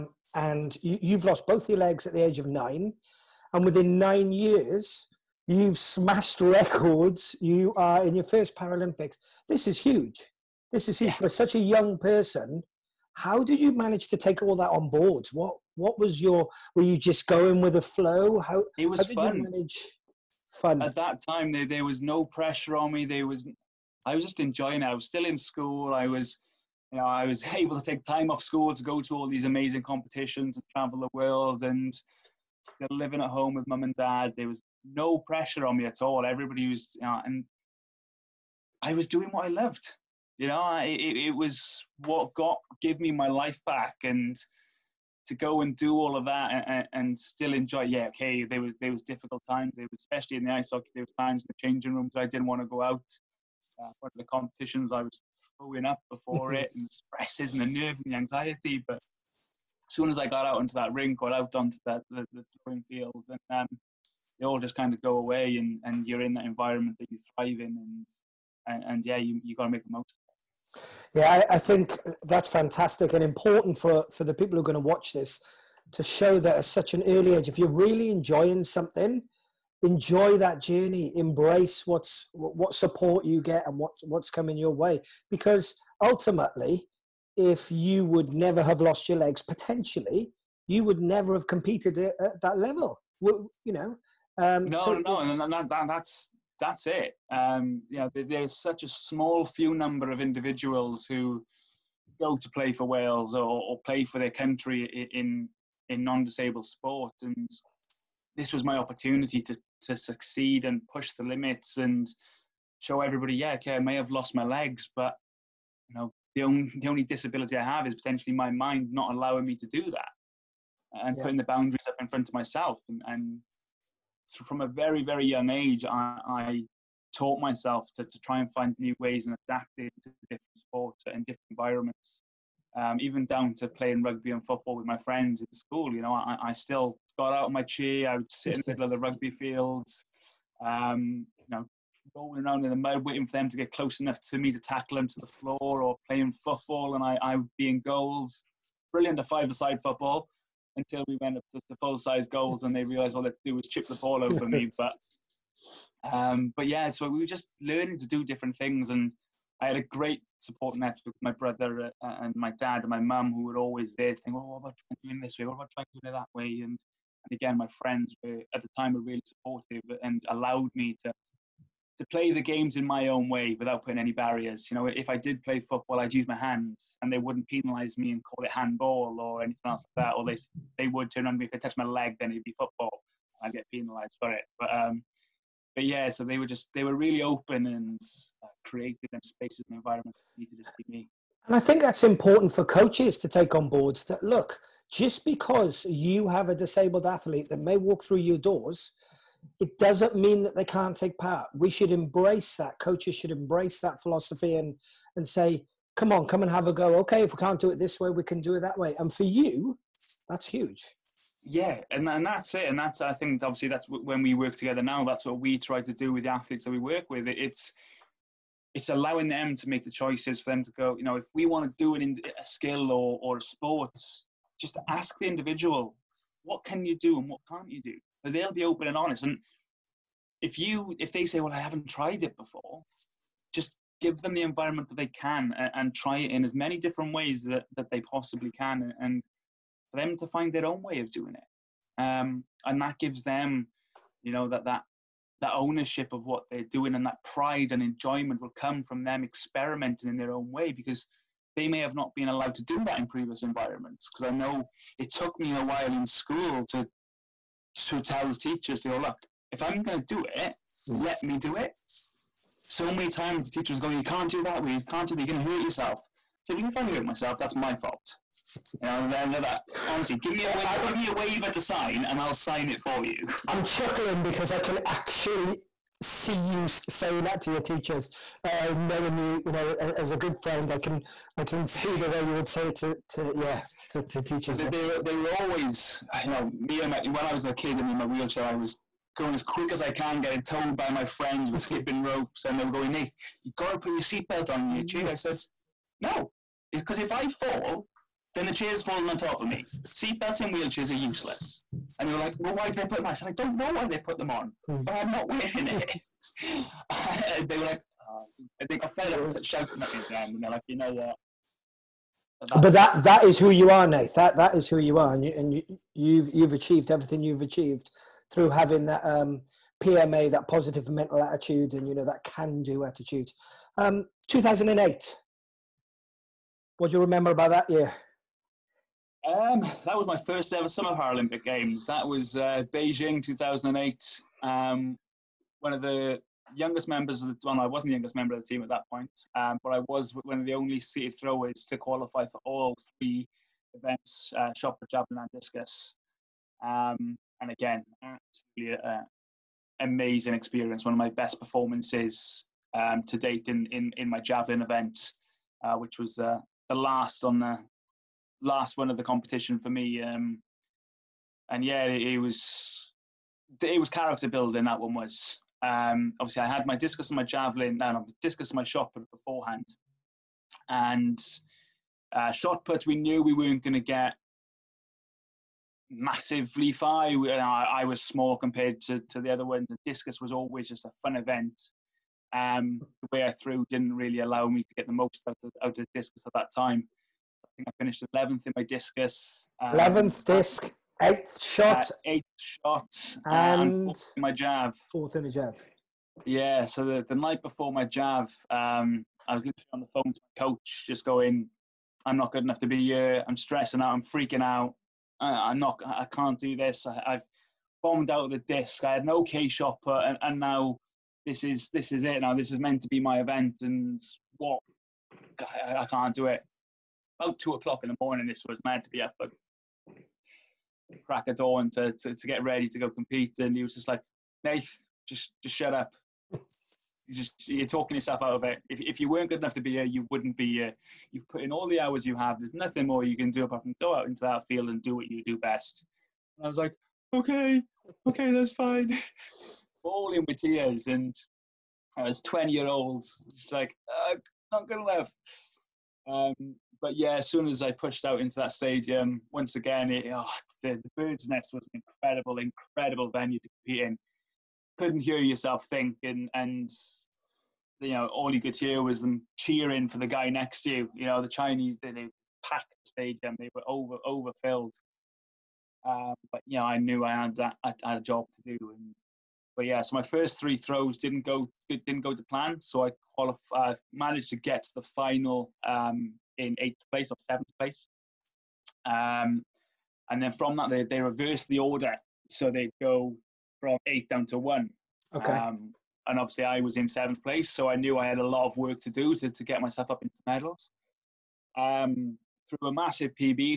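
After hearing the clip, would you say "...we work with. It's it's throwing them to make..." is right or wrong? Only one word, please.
wrong.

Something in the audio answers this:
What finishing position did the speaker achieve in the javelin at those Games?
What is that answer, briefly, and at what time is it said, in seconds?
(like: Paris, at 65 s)
4th, at 394 s.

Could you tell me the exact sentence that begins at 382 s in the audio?
Um, the way I threw didn't really allow me to get the most out of, out of discus at that time.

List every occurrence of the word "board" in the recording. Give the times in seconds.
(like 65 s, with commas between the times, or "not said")
14 s, 193 s.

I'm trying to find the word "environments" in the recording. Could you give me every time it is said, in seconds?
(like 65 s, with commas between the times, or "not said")
66 s, 131 s, 189 s, 234 s, 253 s.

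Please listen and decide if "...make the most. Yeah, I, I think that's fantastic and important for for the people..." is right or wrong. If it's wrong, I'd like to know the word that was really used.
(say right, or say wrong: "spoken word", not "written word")
right.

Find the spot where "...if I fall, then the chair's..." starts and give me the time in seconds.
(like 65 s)
296 s.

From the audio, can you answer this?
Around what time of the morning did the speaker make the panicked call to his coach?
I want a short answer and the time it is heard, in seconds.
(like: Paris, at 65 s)
2 o'clock, at 417 s.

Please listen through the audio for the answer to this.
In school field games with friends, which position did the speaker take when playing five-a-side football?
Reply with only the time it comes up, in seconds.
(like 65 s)
147 s.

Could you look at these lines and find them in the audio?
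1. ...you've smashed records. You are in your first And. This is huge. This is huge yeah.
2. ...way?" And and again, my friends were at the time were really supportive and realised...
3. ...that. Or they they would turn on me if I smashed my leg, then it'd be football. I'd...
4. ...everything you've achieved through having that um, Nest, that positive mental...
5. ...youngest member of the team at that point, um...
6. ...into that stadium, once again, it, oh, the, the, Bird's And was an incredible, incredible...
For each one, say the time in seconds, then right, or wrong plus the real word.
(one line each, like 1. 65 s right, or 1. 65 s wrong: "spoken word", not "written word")
1. 5 s wrong: "Paralympics", not "And"
2. 166 s wrong: "allowed", not "realised"
3. 180 s wrong: "touched", not "smashed"
4. 316 s wrong: "PMA", not "Nest"
5. 337 s right
6. 448 s wrong: "Nest", not "And".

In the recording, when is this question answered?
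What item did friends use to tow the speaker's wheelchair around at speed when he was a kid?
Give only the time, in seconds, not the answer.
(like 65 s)
291 s.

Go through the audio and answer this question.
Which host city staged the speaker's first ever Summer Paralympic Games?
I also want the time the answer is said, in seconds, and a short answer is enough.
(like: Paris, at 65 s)
Beijing, at 332 s.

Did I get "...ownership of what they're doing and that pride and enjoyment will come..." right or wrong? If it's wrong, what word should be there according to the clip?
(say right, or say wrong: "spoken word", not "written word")
right.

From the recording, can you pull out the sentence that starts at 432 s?
There's nothing more you can do apart from go out into that field and do what you do best.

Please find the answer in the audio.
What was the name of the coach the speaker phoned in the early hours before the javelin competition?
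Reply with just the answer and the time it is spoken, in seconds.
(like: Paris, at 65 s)
Owen, at 421 s.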